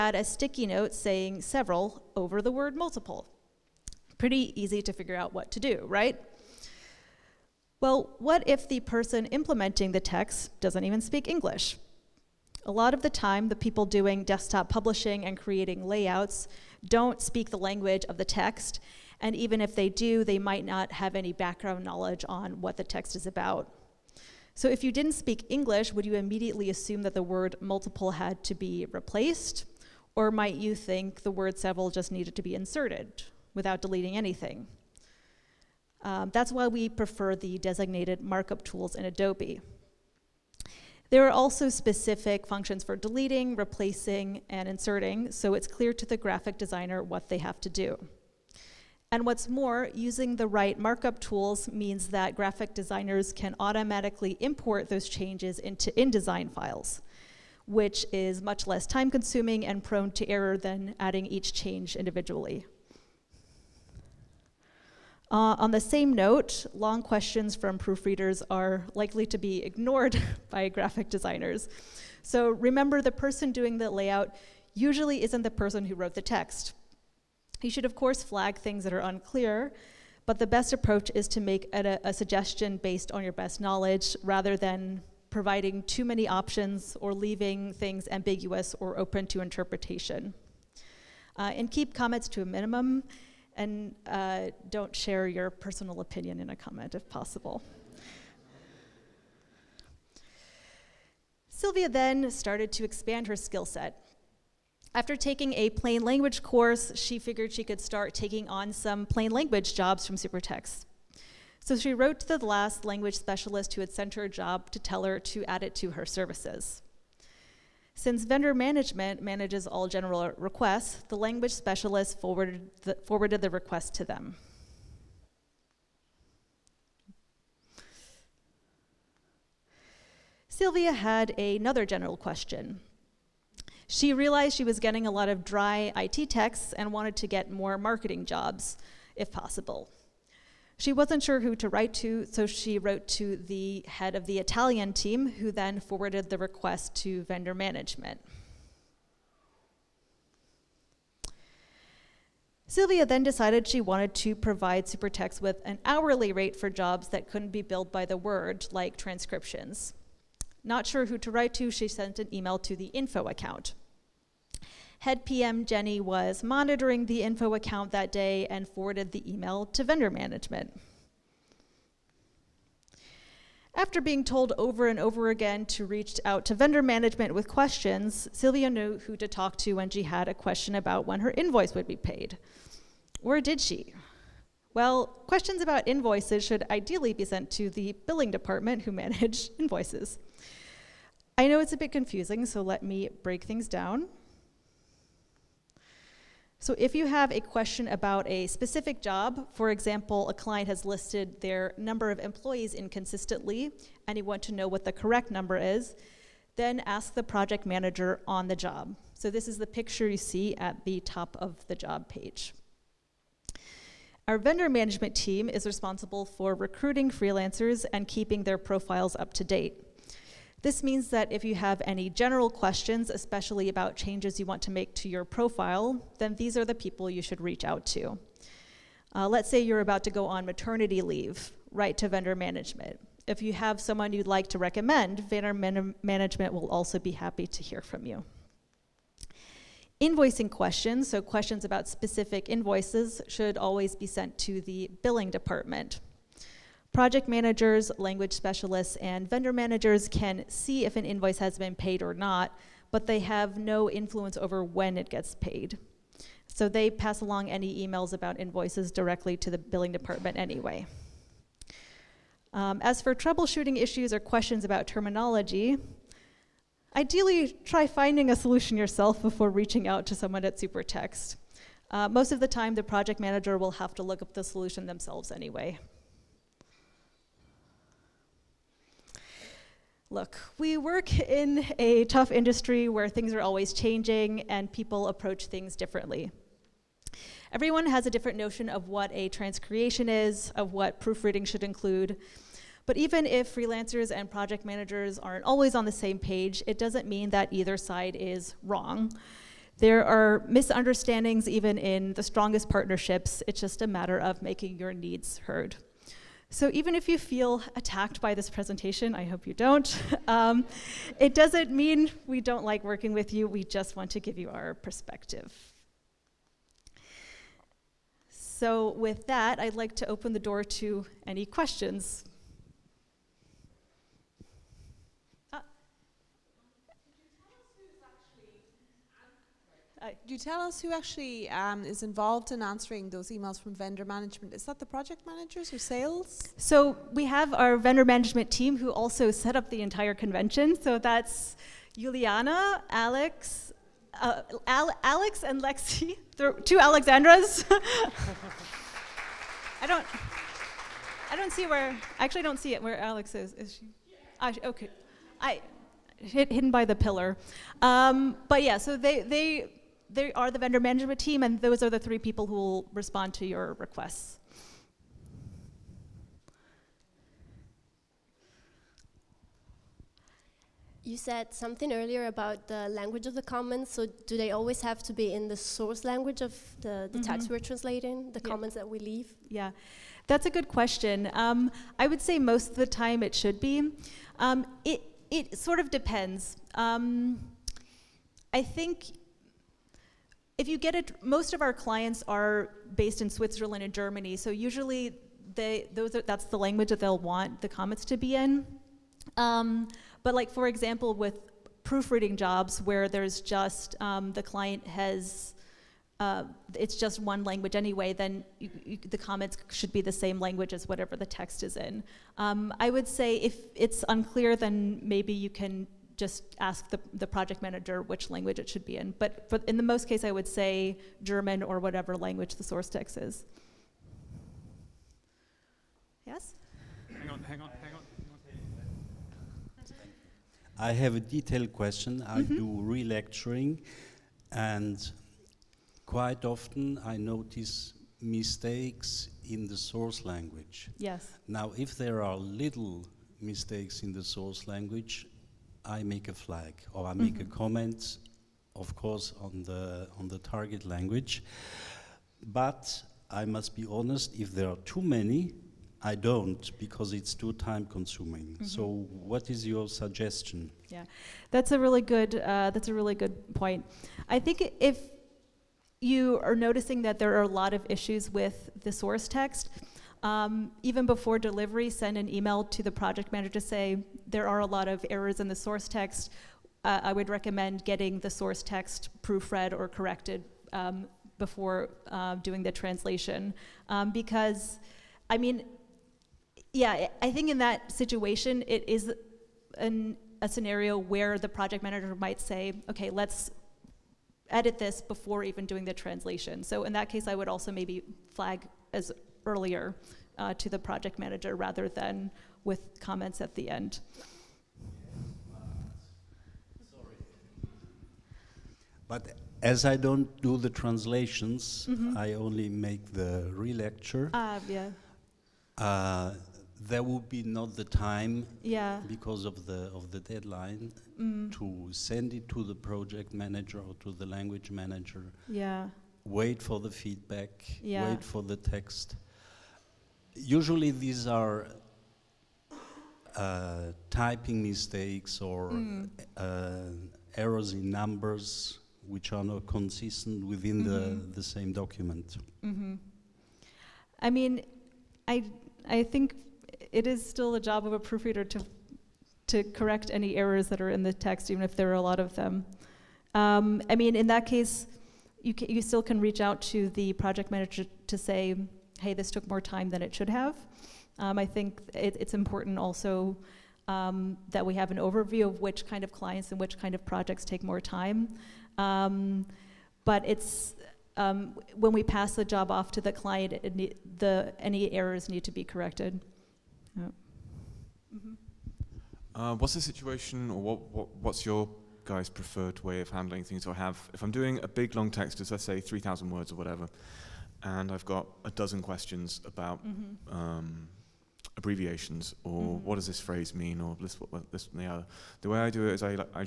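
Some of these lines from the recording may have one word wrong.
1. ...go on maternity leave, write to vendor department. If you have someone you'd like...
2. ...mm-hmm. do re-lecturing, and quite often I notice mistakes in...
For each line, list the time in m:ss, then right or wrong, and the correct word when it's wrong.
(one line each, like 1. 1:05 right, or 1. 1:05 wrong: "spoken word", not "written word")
1. 3:50 wrong: "management", not "department"
2. 7:12 right.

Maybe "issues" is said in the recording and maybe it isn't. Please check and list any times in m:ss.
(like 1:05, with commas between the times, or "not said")
4:23, 7:47.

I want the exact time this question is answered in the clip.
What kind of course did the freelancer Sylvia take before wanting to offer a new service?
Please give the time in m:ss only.
1:45.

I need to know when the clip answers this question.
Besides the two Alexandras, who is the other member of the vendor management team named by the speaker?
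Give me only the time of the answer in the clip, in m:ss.
5:41.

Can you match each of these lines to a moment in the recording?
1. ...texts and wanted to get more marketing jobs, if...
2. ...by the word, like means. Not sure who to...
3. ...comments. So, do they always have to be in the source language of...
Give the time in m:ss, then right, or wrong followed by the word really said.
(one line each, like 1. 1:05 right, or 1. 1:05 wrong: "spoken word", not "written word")
1. 2:16 right
2. 2:37 wrong: "transcriptions", not "means"
3. 6:13 right.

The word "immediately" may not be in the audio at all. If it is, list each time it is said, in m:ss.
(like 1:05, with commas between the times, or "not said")
0:26.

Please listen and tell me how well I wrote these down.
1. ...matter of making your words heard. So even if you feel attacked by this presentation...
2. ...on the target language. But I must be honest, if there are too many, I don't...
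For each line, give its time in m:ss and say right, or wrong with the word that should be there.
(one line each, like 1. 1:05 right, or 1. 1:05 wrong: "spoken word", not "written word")
1. 5:03 wrong: "needs", not "words"
2. 7:30 right.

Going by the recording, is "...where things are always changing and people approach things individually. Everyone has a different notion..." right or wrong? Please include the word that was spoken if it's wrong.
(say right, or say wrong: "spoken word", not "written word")
wrong: "differently", not "individually".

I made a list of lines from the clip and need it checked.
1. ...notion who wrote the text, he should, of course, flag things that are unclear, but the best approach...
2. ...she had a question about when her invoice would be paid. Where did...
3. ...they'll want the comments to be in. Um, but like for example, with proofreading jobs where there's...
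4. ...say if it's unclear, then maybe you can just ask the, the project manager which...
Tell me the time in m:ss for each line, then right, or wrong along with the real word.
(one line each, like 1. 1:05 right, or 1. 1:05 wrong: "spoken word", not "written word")
1. 1:15 wrong: "person", not "notion"
2. 2:59 right
3. 6:36 right
4. 6:53 right.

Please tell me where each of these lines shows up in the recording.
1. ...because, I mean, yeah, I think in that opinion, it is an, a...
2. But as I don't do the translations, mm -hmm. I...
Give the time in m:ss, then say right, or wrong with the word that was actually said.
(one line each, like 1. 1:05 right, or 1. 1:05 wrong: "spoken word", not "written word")
1. 8:04 wrong: "situation", not "opinion"
2. 8:29 right.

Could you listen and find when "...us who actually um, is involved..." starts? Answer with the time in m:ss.
5:30.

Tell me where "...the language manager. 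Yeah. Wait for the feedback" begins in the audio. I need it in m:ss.
8:44.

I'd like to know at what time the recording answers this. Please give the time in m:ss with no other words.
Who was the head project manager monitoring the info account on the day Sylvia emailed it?
2:45.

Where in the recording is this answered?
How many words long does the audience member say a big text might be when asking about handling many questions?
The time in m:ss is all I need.
9:45.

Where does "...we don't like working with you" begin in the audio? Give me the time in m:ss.
5:12.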